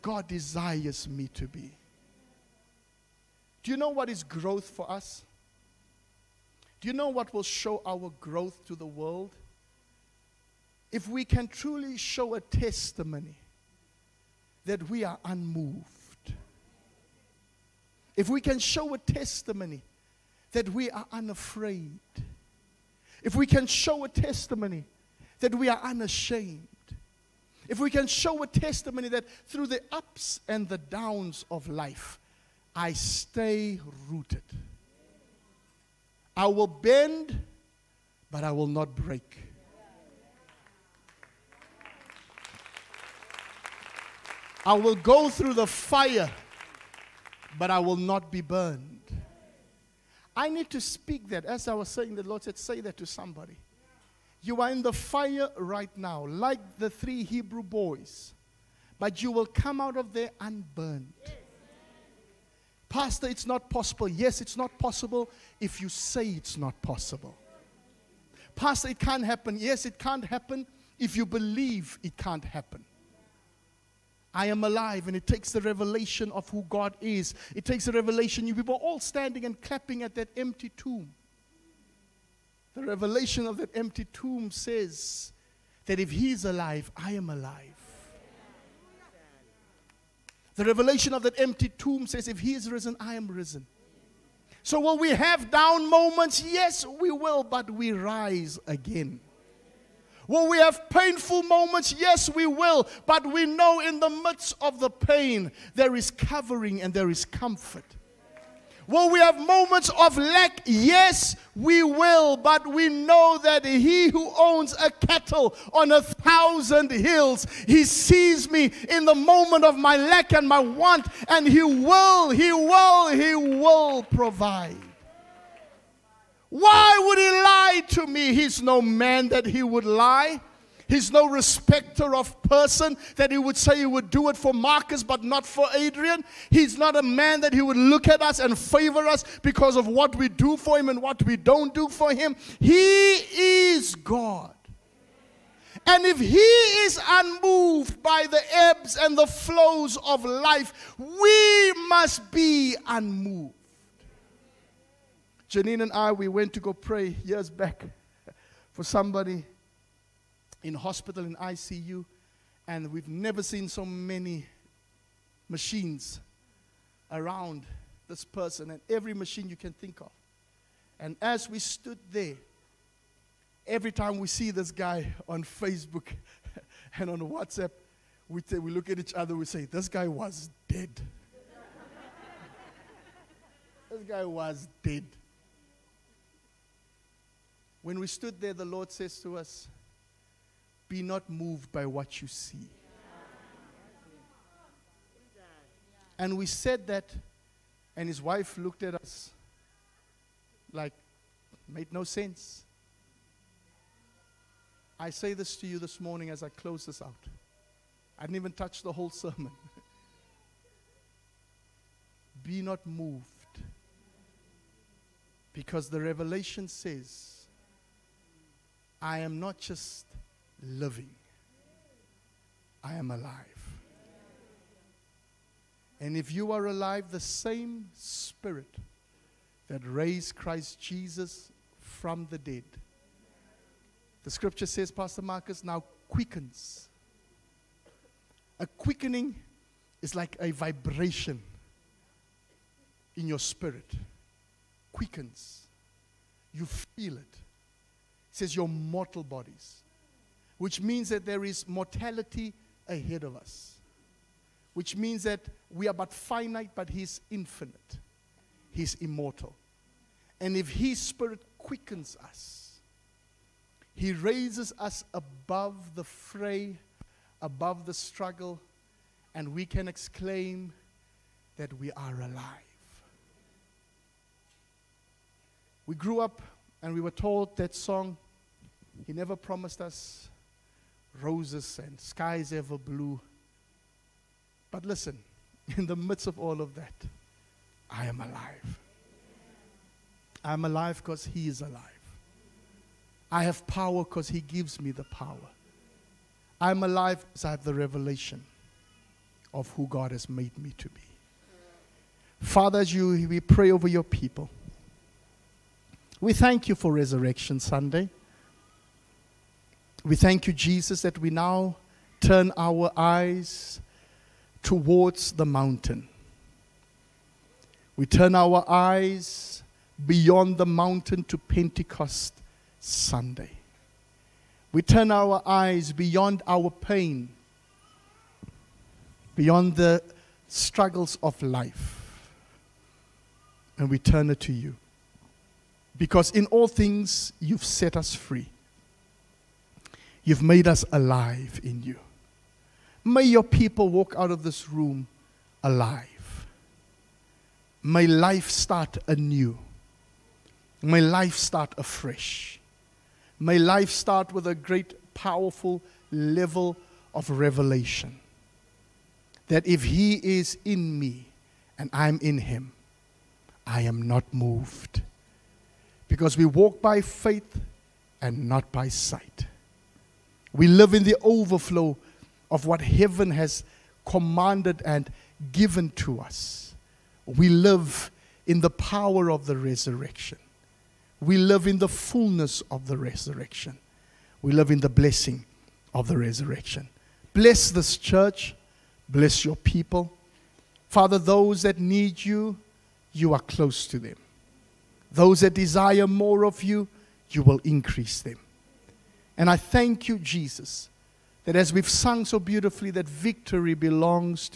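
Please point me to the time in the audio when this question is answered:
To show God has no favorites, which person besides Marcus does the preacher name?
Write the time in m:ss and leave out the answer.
2:15.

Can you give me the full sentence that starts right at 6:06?
Because we walk by faith and not by sight.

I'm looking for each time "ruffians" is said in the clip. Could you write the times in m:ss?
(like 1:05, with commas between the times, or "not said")
not said.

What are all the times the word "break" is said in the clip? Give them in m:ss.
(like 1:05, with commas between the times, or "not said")
0:38.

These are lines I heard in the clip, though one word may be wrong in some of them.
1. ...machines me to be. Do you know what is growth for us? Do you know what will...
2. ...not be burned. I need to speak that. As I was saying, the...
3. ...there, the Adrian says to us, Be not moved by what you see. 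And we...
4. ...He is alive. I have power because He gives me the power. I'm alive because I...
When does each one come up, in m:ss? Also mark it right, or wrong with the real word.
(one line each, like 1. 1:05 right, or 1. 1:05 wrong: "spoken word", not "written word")
1. 0:00 wrong: "desires", not "machines"
2. 0:47 right
3. 3:08 wrong: "Lord", not "Adrian"
4. 4:51 right.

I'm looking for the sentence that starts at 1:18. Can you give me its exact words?
We were all standing and clapping at that empty tomb.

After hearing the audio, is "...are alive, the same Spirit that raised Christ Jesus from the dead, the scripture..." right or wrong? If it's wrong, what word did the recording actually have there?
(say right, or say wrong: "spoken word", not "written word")
right.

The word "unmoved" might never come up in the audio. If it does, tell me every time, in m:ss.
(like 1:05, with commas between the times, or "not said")
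0:15, 2:27, 2:32.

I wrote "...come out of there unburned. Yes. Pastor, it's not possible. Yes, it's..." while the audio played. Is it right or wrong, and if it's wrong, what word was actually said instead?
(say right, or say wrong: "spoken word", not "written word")
right.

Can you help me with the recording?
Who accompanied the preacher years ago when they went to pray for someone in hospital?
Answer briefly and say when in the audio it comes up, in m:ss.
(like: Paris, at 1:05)
Janine, at 2:35.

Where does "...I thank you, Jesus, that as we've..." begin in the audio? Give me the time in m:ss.
6:39.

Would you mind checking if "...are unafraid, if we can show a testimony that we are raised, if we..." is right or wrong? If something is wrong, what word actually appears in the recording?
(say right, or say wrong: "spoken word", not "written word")
wrong: "unashamed", not "raised".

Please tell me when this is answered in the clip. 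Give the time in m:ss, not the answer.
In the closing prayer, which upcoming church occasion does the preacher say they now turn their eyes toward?
5:21.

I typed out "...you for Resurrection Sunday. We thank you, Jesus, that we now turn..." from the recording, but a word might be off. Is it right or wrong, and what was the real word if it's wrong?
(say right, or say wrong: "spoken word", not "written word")
right.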